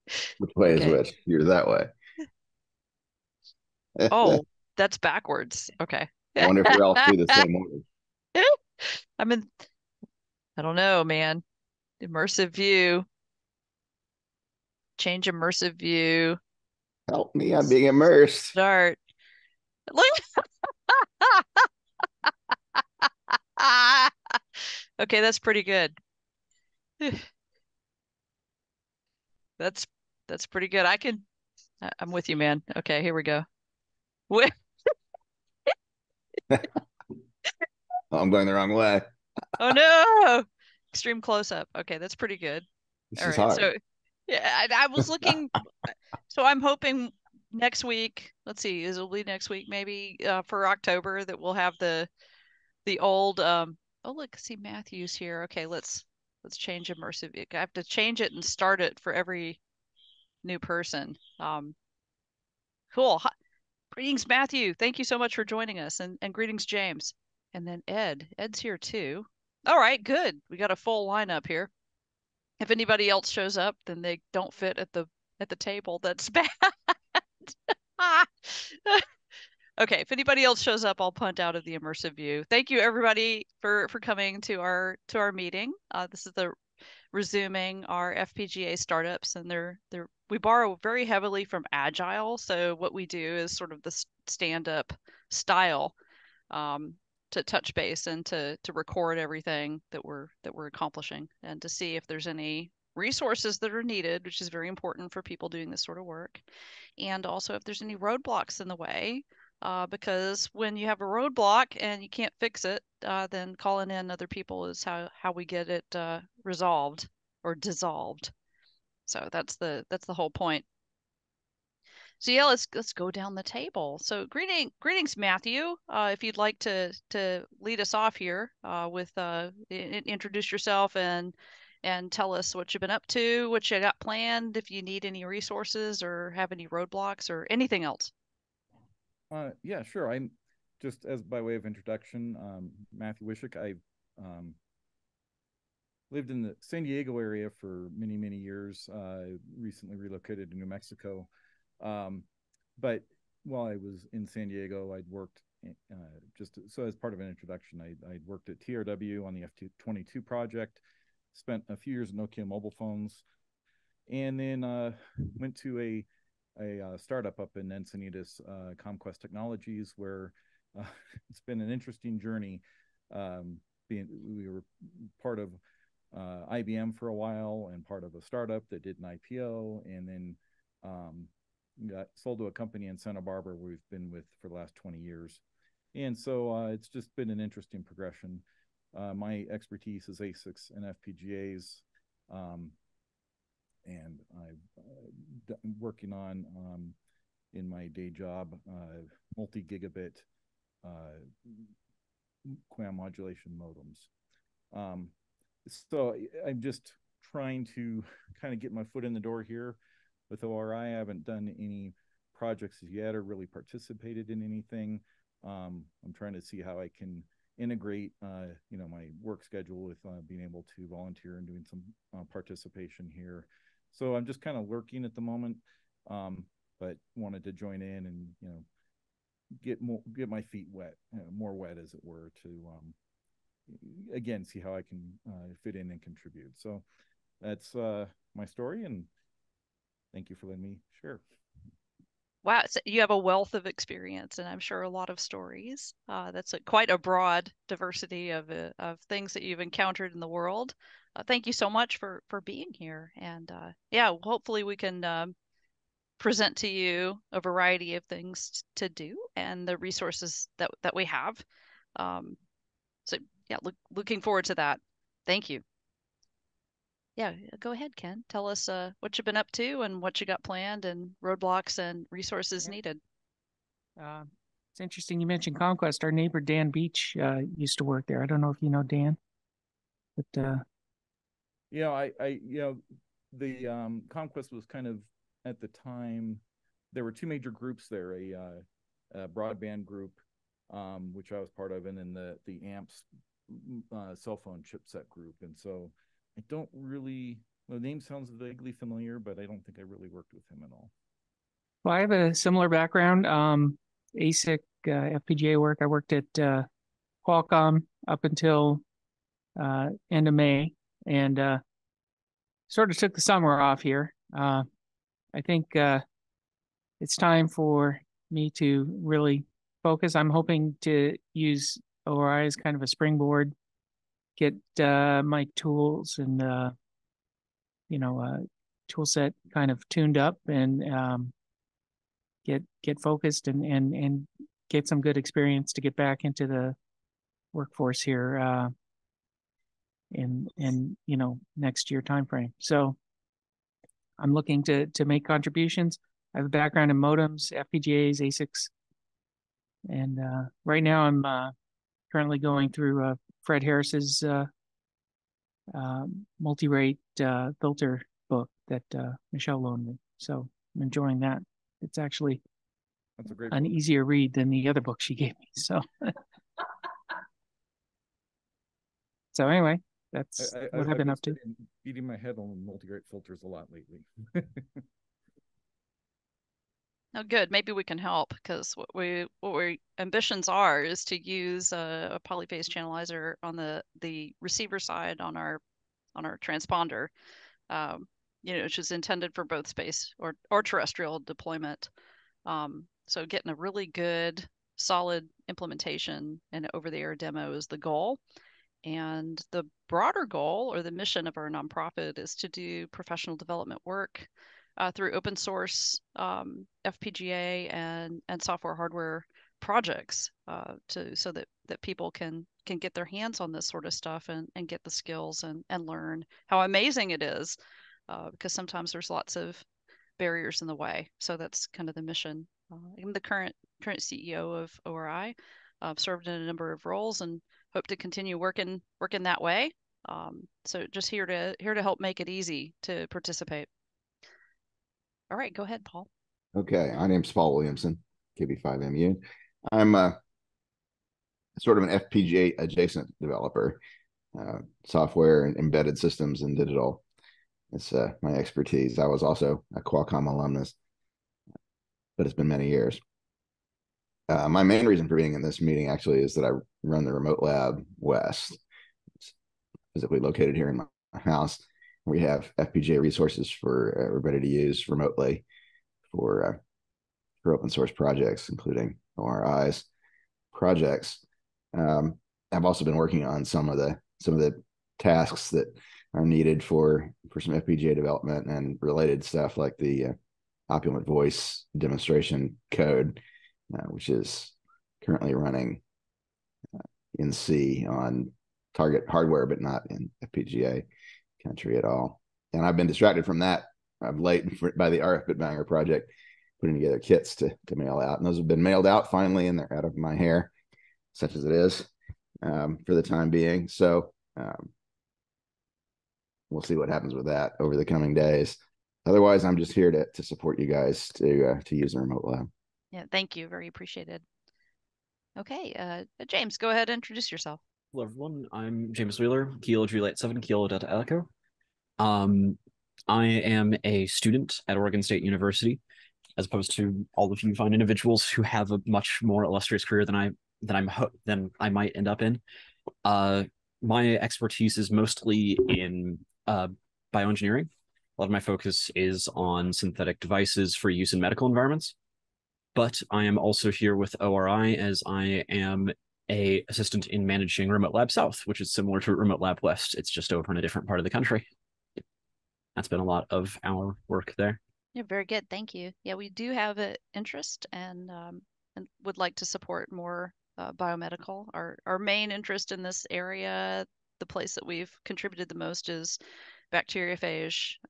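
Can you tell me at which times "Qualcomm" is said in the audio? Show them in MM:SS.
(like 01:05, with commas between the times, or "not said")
05:07, 07:29.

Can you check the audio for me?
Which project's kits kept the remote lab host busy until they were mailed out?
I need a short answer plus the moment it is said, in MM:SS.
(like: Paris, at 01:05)
RF Bitbanger, at 08:14.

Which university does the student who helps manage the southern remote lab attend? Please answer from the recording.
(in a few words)
Oregon State University.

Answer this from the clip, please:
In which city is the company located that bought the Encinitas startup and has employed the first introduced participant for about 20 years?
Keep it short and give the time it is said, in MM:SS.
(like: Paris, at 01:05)
Santa Barbara, at 03:02.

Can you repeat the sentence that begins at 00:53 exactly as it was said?
um Oh look, see Matthews here.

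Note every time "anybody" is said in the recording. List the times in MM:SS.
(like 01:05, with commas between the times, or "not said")
01:12, 01:20.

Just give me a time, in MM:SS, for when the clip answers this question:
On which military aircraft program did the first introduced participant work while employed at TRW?
02:39.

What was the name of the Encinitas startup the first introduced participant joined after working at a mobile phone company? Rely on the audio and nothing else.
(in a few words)
Comquest Technologies.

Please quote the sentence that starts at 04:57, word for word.
Well, the name sounds vaguely familiar, but I don't think I really worked with him at all.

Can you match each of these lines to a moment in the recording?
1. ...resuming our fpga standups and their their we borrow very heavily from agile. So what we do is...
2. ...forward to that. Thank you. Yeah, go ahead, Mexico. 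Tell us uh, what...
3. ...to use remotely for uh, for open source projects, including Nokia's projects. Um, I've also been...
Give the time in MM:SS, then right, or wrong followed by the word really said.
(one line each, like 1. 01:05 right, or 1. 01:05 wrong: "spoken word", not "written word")
1. 01:27 right
2. 04:24 wrong: "Ken", not "Mexico"
3. 07:44 wrong: "ORI", not "Nokia".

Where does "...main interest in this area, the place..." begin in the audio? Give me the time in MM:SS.
09:21.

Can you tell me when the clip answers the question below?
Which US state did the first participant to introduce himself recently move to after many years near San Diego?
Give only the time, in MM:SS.
02:30.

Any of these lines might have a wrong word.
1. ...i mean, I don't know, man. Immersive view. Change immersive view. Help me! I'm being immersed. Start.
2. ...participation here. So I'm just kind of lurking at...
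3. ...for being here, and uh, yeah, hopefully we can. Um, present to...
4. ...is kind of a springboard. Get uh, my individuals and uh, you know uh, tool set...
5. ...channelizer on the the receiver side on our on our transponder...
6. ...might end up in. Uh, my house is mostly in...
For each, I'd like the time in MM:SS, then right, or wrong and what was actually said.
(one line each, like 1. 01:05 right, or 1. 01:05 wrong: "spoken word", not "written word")
1. 00:09 right
2. 03:42 right
3. 04:12 right
4. 05:22 wrong: "tools", not "individuals"
5. 06:22 right
6. 08:51 wrong: "expertise", not "house".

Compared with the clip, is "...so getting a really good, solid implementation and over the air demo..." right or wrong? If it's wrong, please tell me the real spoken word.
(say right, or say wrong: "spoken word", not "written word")
right.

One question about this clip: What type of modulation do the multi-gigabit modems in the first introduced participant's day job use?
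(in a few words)
QAM.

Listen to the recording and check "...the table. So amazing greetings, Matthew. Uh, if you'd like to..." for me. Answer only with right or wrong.
wrong.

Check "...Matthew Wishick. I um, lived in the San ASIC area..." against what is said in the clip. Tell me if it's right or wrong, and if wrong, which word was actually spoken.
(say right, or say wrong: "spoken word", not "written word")
wrong: "Diego", not "ASIC".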